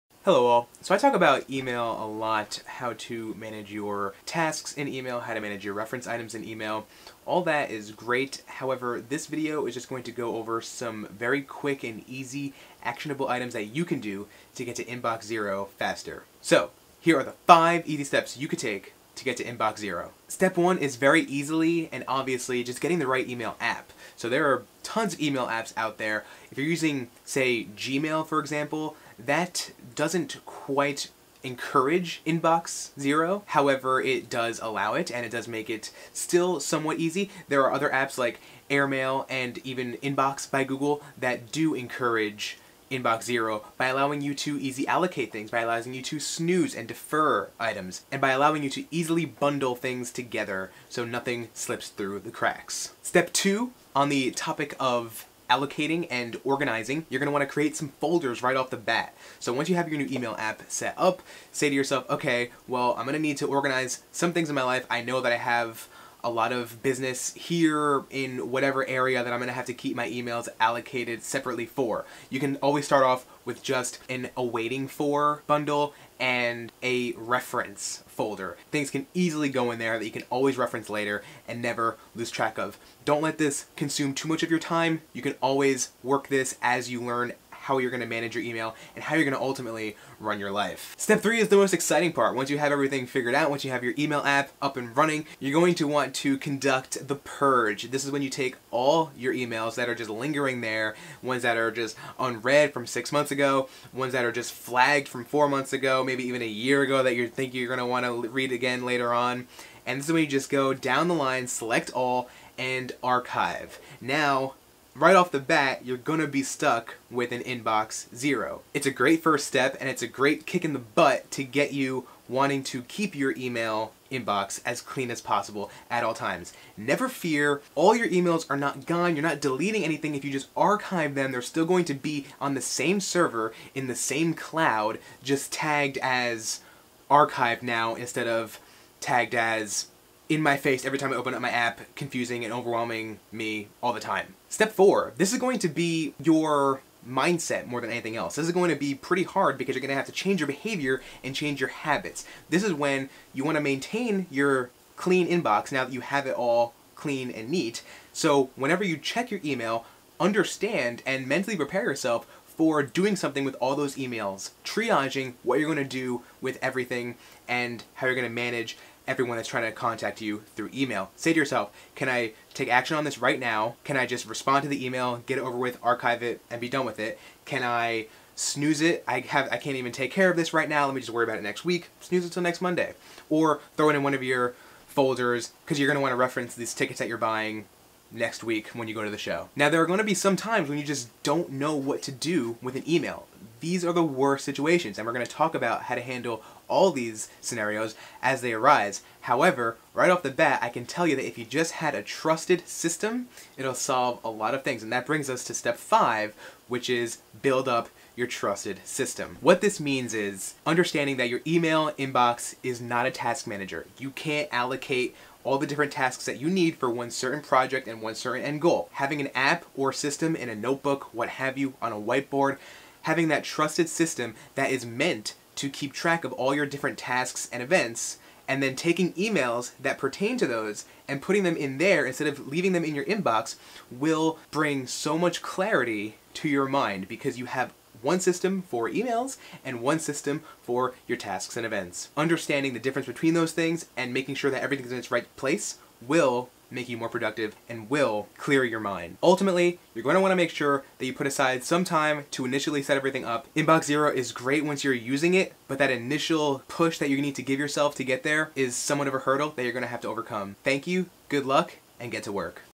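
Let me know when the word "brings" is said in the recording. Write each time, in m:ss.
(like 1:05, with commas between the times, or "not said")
3:25, 3:54.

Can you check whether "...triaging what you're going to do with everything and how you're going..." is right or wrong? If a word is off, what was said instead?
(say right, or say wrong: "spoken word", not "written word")
right.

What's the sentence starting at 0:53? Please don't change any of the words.
Step two, on the topic of allocating and organizing, you're gonna wanna create some folders right off the bat.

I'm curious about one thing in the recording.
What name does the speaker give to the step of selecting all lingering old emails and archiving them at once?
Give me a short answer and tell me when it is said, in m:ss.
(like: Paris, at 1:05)
the purge, at 1:37.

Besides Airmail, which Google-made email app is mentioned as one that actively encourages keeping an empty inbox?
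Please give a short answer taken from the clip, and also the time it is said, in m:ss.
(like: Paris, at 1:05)
Inbox by Google, at 0:39.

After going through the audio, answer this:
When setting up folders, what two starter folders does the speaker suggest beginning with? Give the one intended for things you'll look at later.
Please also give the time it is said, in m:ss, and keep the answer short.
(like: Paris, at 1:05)
reference folder, at 1:17.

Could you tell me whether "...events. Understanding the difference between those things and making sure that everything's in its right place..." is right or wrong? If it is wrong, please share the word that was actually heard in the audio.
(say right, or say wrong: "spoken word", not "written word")
right.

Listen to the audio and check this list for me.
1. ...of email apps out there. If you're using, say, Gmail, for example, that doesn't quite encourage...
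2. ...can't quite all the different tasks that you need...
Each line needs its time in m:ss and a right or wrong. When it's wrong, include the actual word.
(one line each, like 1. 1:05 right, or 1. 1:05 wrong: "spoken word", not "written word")
1. 0:25 right
2. 3:34 wrong: "allocate", not "quite".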